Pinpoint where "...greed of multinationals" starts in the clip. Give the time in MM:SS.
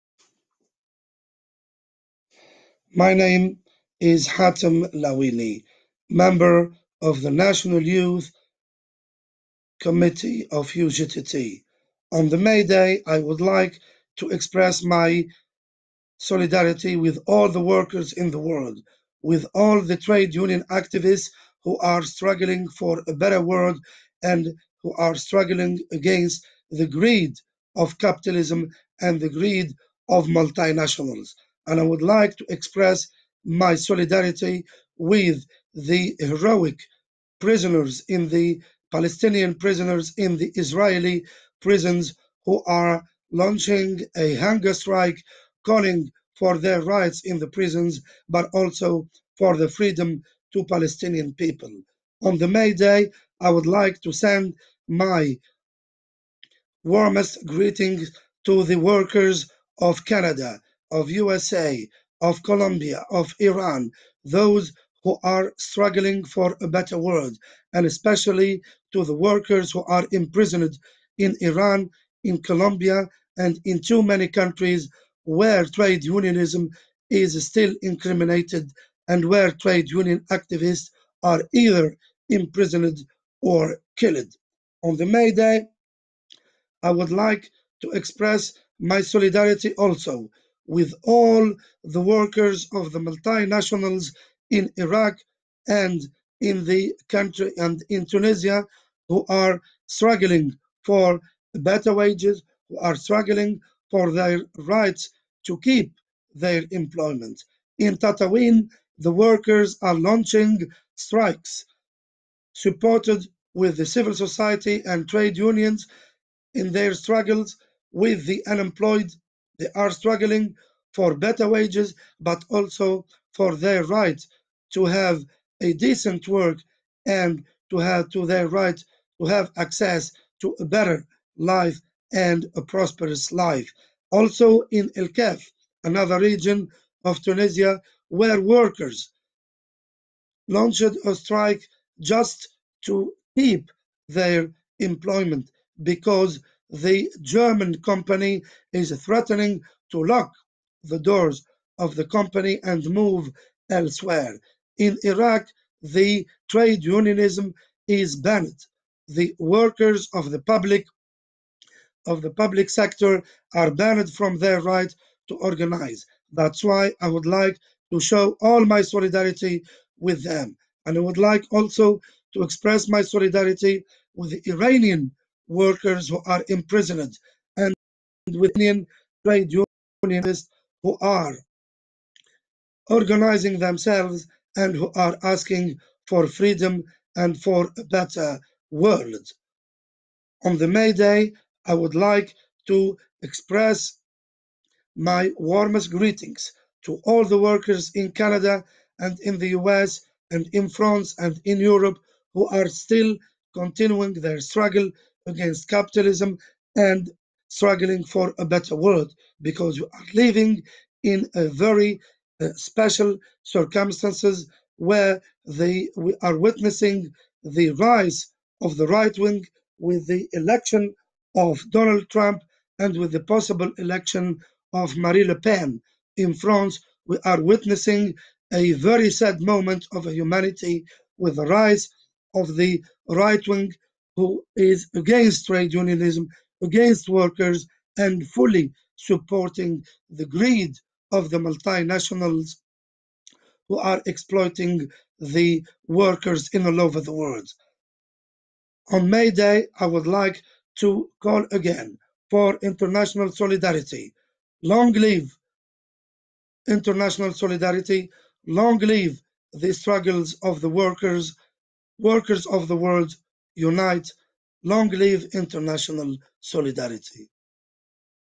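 00:29.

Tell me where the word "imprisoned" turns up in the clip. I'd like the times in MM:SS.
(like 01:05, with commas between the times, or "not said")
01:10, 01:22, 02:56.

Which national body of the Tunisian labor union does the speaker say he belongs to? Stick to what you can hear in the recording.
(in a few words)
National Youth Committee.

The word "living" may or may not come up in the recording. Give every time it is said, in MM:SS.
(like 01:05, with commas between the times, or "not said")
03:30.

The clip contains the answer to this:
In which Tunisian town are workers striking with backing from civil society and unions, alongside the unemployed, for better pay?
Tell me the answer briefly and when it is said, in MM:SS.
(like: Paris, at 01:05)
Tatawin, at 01:47.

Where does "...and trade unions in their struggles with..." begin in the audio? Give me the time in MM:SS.
01:54.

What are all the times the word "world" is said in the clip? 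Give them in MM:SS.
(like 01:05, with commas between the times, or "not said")
00:18, 00:23, 01:06, 03:08, 03:28, 04:07, 04:22.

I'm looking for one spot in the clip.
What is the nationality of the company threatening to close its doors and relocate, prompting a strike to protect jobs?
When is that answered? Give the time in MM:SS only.
02:27.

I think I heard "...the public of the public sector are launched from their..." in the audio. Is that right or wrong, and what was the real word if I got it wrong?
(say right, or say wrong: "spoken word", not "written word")
wrong: "banned", not "launched".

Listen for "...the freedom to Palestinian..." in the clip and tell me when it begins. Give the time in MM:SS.
00:49.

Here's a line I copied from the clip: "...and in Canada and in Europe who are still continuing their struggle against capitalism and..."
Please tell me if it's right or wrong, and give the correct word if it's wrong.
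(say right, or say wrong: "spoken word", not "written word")
wrong: "France", not "Canada".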